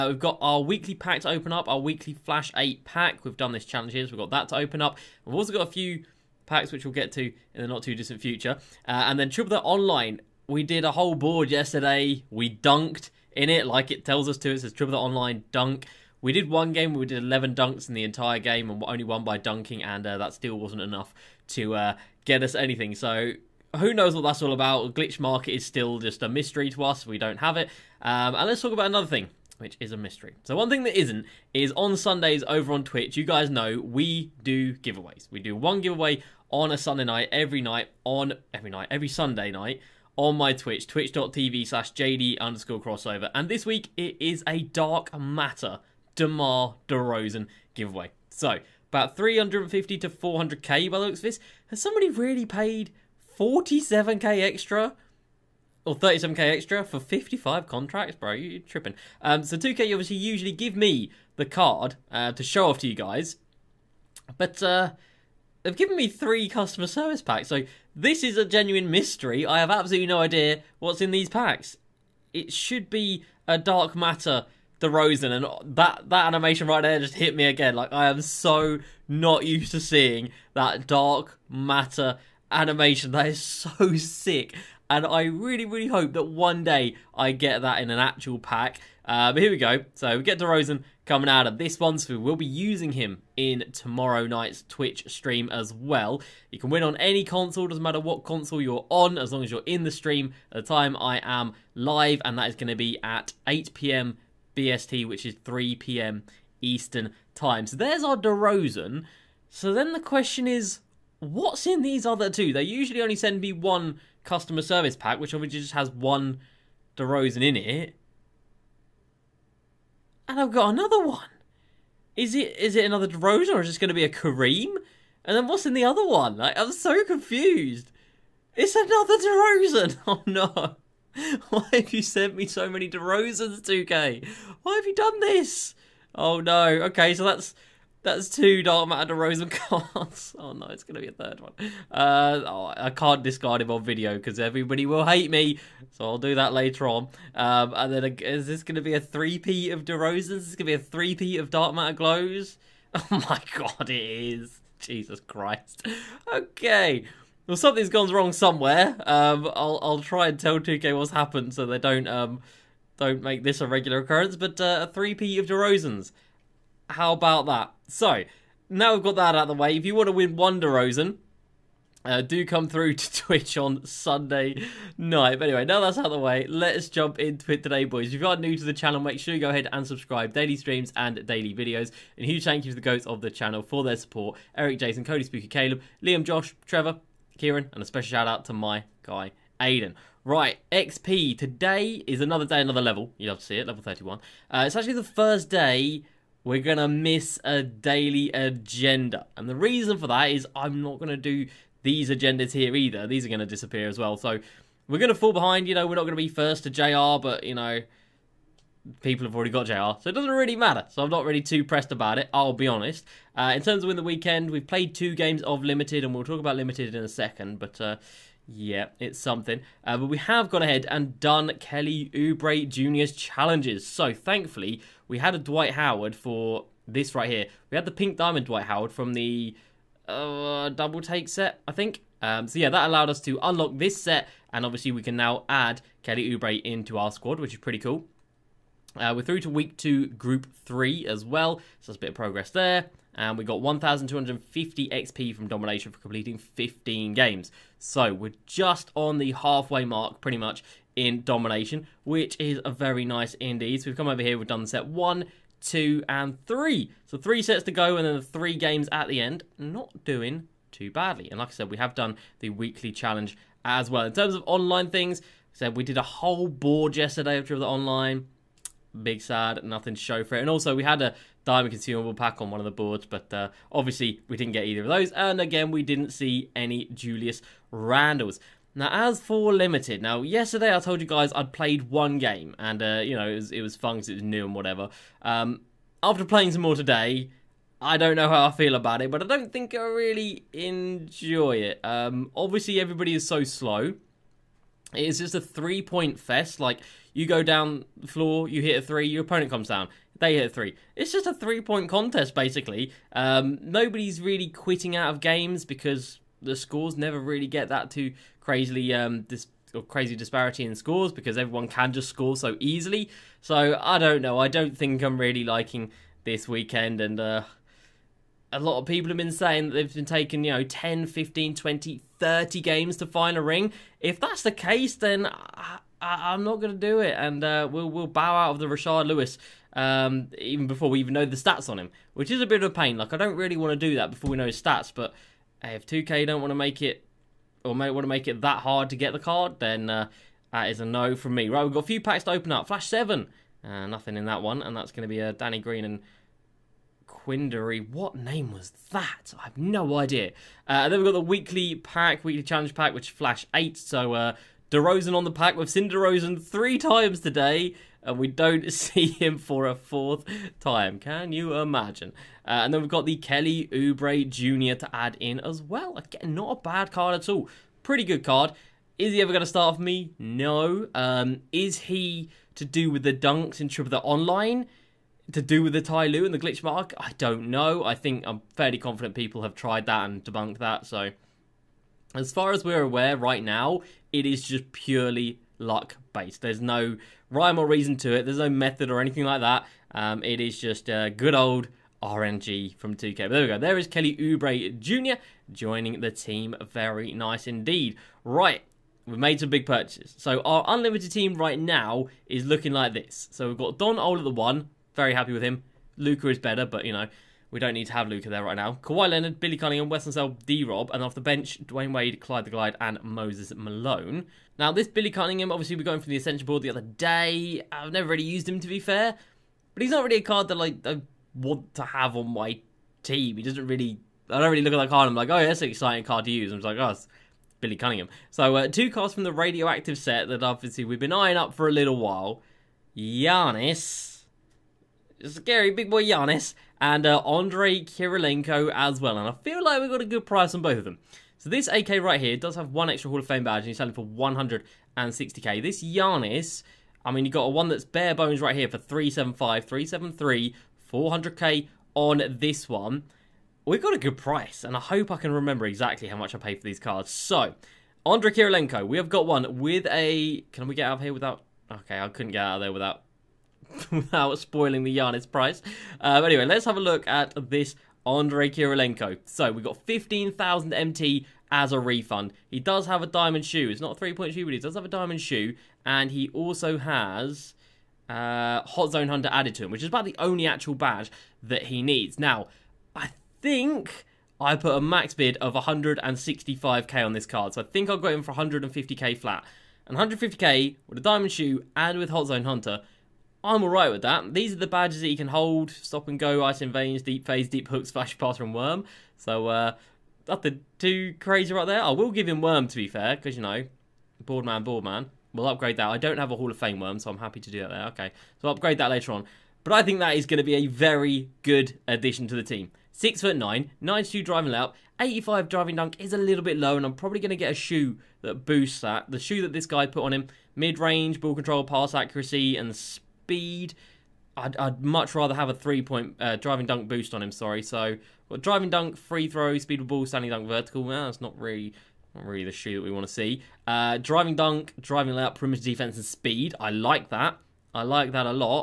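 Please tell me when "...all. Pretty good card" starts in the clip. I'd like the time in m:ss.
6:07.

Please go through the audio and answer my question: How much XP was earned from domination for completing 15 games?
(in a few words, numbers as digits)
1,250.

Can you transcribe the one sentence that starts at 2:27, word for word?
Um, and then is this gonna be a 3 P of DeRozans?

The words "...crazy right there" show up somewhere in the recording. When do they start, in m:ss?
8:21.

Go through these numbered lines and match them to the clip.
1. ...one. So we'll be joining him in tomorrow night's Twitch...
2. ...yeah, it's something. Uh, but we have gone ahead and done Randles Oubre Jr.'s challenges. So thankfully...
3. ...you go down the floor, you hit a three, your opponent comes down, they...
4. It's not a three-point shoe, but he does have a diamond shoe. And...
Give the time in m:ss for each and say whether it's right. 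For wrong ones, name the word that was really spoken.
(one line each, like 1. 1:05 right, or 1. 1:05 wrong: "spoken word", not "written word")
1. 1:31 wrong: "using", not "joining"
2. 3:38 wrong: "Kelly", not "Randles"
3. 4:57 right
4. 7:53 right.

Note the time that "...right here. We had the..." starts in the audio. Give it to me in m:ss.
3:47.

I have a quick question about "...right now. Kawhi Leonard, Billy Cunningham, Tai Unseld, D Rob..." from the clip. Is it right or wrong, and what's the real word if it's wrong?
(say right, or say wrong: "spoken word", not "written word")
wrong: "Wes", not "Tai".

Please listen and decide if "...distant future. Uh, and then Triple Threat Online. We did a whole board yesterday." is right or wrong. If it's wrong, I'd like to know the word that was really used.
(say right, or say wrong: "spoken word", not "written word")
right.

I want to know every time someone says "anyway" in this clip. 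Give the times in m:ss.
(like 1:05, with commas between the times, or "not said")
2:55, 7:46.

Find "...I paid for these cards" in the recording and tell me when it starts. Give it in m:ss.
7:36.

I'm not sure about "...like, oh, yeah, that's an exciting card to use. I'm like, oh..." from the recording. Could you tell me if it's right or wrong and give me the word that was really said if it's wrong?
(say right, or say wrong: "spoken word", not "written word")
right.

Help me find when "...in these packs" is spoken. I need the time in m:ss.
1:11.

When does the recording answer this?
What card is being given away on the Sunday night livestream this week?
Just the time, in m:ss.
0:44.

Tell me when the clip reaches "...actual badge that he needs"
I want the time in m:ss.
8:00.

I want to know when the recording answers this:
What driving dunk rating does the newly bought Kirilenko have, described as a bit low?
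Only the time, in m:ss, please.
8:34.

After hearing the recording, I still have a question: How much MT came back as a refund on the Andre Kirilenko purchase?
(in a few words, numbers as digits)
15,000 MT.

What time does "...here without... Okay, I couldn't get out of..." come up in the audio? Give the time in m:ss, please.
7:41.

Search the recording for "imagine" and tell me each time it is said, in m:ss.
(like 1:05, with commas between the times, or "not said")
6:01.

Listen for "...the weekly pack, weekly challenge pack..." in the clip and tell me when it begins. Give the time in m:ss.
5:51.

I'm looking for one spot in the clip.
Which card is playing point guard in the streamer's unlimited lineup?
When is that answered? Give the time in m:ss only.
6:43.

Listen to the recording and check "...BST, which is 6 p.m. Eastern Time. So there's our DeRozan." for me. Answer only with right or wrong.
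wrong.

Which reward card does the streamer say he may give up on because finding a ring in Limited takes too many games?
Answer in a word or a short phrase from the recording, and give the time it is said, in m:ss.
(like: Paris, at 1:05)
Rashard Lewis, at 5:28.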